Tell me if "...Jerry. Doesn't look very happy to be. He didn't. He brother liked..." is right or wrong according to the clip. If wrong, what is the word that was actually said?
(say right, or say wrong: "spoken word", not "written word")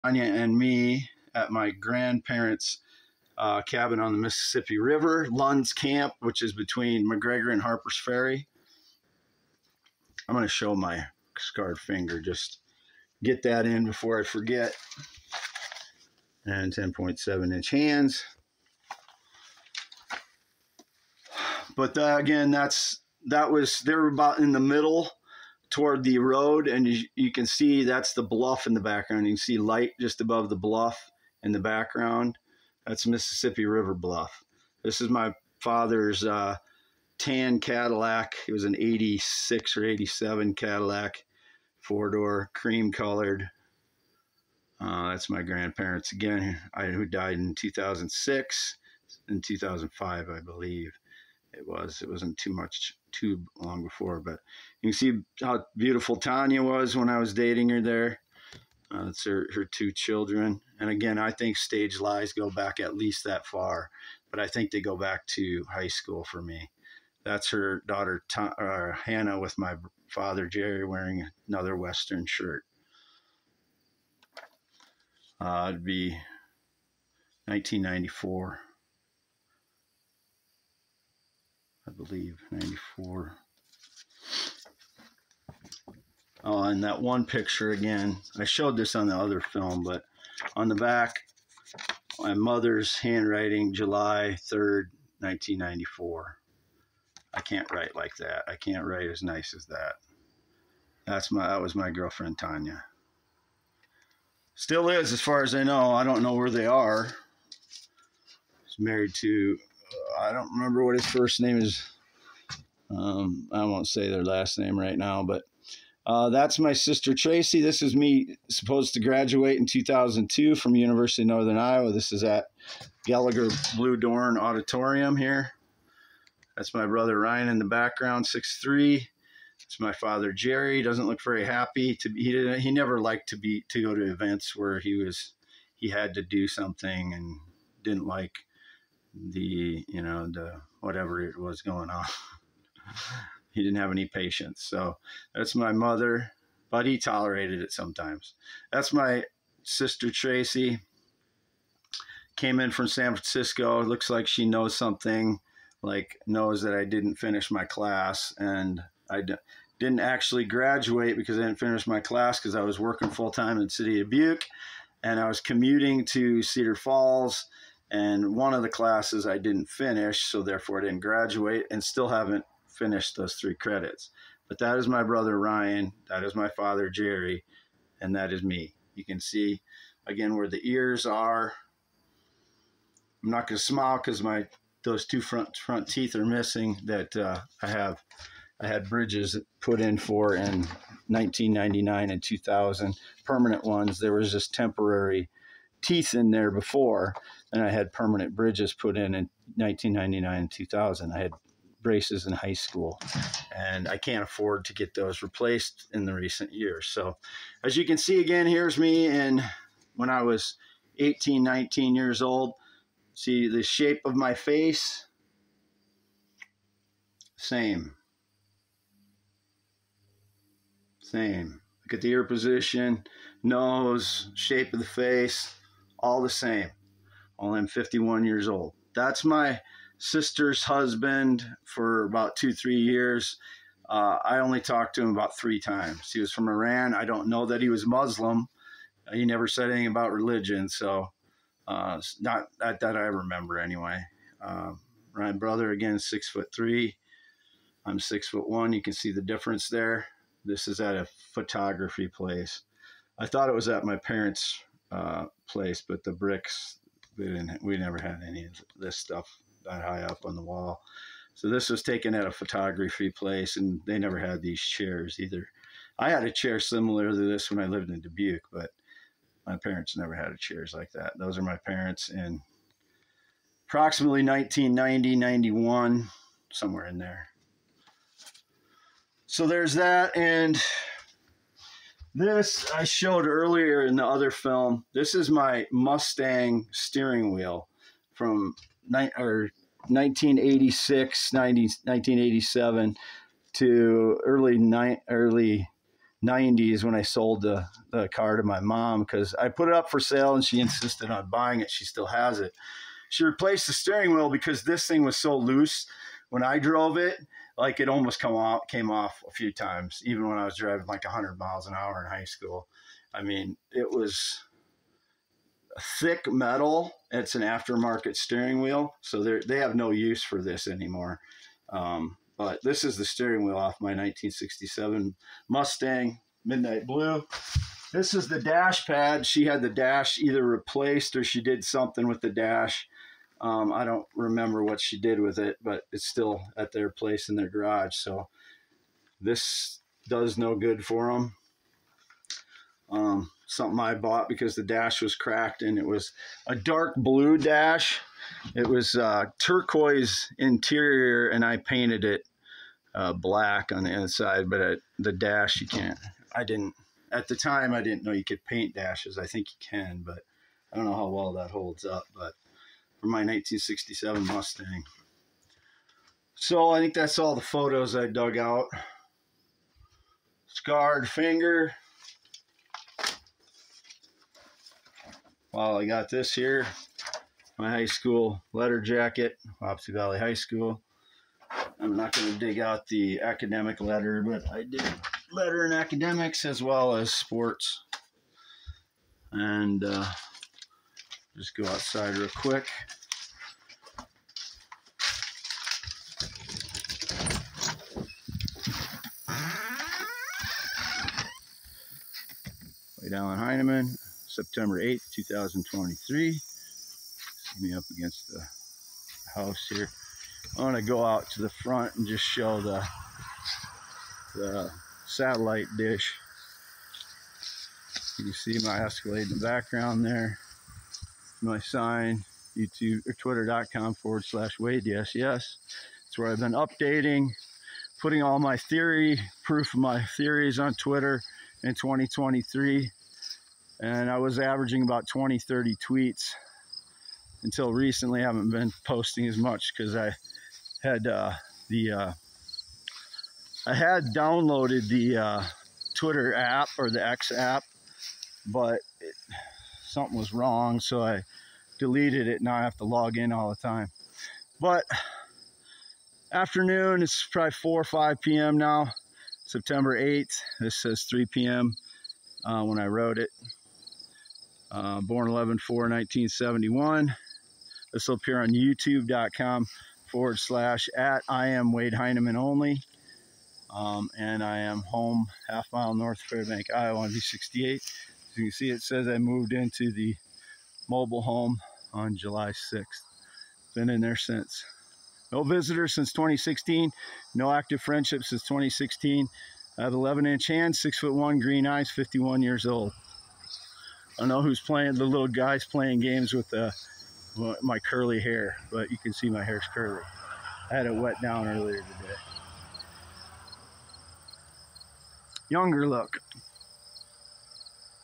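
wrong: "never", not "brother".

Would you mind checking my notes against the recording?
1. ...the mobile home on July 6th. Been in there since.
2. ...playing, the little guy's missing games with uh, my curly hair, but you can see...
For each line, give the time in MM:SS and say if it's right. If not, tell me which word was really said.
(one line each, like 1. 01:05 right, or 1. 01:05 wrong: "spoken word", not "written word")
1. 07:59 right
2. 08:14 wrong: "playing", not "missing".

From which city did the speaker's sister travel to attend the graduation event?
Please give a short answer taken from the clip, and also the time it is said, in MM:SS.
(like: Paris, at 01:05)
San Francisco, at 02:32.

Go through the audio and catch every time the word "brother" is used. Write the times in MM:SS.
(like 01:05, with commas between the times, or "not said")
02:06, 02:55, 04:05.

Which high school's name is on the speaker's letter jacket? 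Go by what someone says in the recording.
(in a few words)
Wapsie Valley High School.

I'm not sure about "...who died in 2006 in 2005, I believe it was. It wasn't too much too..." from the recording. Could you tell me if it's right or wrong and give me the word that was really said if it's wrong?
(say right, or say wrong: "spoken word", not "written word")
right.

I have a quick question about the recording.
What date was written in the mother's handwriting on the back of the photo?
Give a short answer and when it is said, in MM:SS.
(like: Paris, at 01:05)
July 3rd, 1994, at 01:33.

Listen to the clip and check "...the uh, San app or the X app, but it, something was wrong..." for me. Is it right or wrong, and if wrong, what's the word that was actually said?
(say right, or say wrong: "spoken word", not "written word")
wrong: "Twitter", not "San".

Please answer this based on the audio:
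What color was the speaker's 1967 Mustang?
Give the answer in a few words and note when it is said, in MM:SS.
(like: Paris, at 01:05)
Midnight Blue, at 05:26.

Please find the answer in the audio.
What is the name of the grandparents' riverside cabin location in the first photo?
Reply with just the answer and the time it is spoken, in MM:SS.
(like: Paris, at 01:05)
Lund's Camp, at 00:05.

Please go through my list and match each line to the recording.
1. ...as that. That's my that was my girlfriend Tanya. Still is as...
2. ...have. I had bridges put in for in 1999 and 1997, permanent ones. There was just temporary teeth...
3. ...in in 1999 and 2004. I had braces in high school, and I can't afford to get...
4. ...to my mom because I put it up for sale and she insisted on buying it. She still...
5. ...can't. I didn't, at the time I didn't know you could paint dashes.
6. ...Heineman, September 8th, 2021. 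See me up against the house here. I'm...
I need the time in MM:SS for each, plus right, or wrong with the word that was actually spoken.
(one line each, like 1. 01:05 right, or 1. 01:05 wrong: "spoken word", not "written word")
1. 01:39 right
2. 03:07 wrong: "2000", not "1997"
3. 03:18 wrong: "2000", not "2004"
4. 04:58 right
5. 05:55 right
6. 06:43 wrong: "2023", not "2021".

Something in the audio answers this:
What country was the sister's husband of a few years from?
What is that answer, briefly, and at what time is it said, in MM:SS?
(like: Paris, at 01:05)
Iran, at 03:56.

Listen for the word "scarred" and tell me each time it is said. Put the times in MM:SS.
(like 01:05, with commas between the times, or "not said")
00:11, 06:10.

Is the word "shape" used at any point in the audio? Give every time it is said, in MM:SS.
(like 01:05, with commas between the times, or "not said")
03:33, 03:44.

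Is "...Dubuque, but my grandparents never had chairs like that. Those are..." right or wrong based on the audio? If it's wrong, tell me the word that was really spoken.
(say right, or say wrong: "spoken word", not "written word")
wrong: "parents", not "grandparents".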